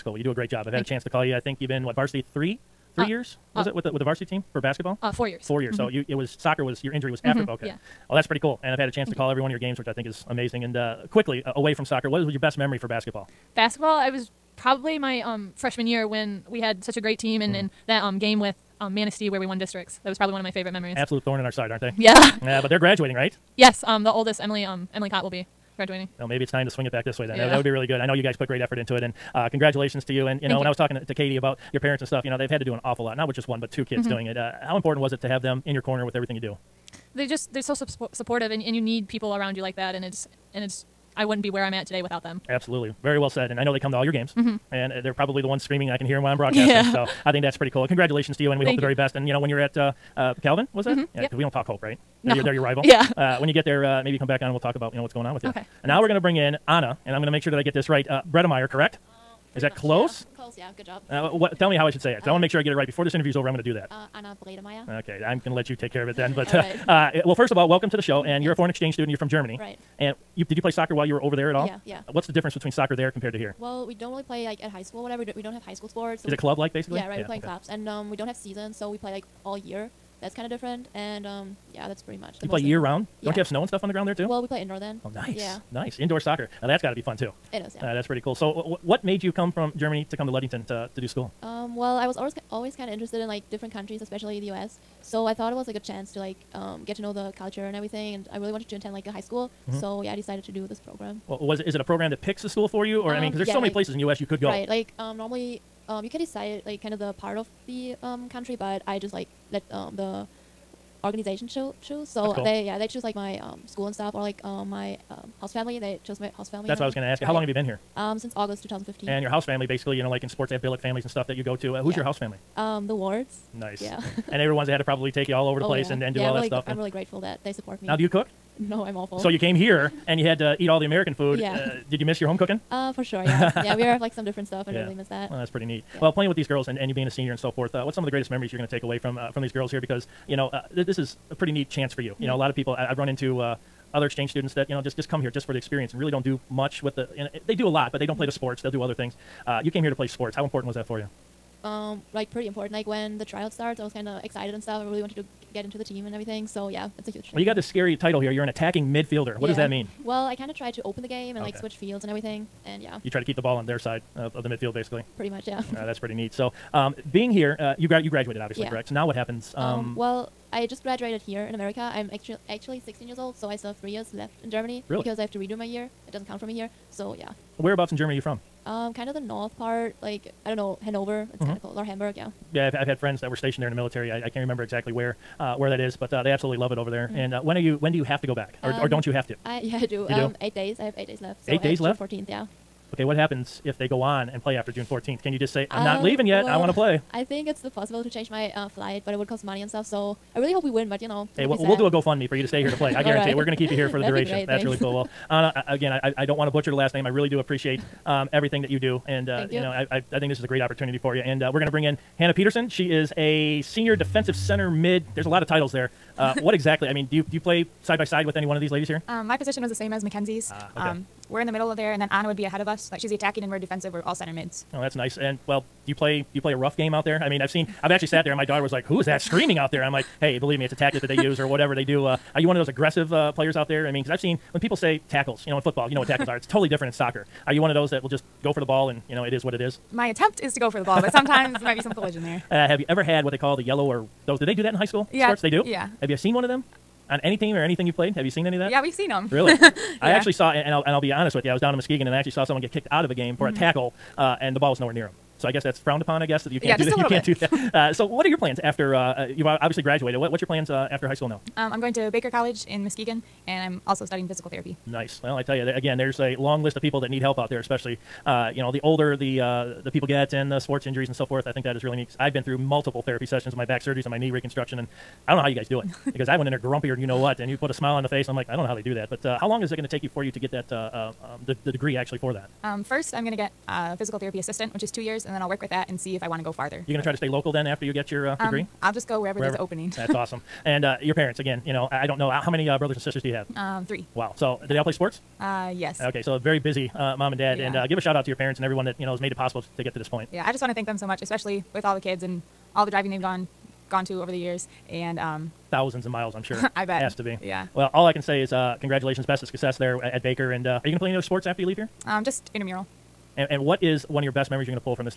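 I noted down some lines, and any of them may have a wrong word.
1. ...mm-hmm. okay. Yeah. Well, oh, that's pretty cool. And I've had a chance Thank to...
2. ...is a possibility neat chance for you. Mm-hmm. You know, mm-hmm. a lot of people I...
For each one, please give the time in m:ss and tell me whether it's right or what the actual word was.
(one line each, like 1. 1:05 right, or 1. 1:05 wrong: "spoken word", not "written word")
1. 0:07 right
2. 2:20 wrong: "pretty", not "possibility".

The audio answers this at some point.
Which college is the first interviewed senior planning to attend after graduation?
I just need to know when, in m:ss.
0:50.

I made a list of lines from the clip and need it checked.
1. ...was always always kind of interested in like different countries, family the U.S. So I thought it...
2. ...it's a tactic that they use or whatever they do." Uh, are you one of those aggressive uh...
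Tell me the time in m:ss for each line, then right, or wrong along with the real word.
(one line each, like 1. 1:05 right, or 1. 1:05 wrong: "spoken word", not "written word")
1. 1:32 wrong: "especially", not "family"
2. 3:50 right.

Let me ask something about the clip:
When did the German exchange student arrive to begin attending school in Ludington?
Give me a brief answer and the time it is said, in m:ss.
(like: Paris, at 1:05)
August 2015, at 1:58.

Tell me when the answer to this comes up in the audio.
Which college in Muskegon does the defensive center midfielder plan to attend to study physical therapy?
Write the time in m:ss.
4:22.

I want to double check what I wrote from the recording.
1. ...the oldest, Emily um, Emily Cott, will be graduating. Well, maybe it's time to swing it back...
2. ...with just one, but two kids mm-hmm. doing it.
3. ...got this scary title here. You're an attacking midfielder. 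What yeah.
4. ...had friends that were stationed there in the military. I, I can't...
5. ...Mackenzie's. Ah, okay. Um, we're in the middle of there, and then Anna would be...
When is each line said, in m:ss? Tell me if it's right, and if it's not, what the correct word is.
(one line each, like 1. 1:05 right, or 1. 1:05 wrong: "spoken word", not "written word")
1. 0:24 right
2. 0:33 right
3. 2:37 right
4. 3:02 right
5. 3:40 right.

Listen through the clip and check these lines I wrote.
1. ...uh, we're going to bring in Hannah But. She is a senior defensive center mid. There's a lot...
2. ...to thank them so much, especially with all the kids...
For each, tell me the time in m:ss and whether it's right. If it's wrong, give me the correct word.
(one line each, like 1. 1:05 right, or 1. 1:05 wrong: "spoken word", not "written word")
1. 3:31 wrong: "Peterson", not "But"
2. 5:00 right.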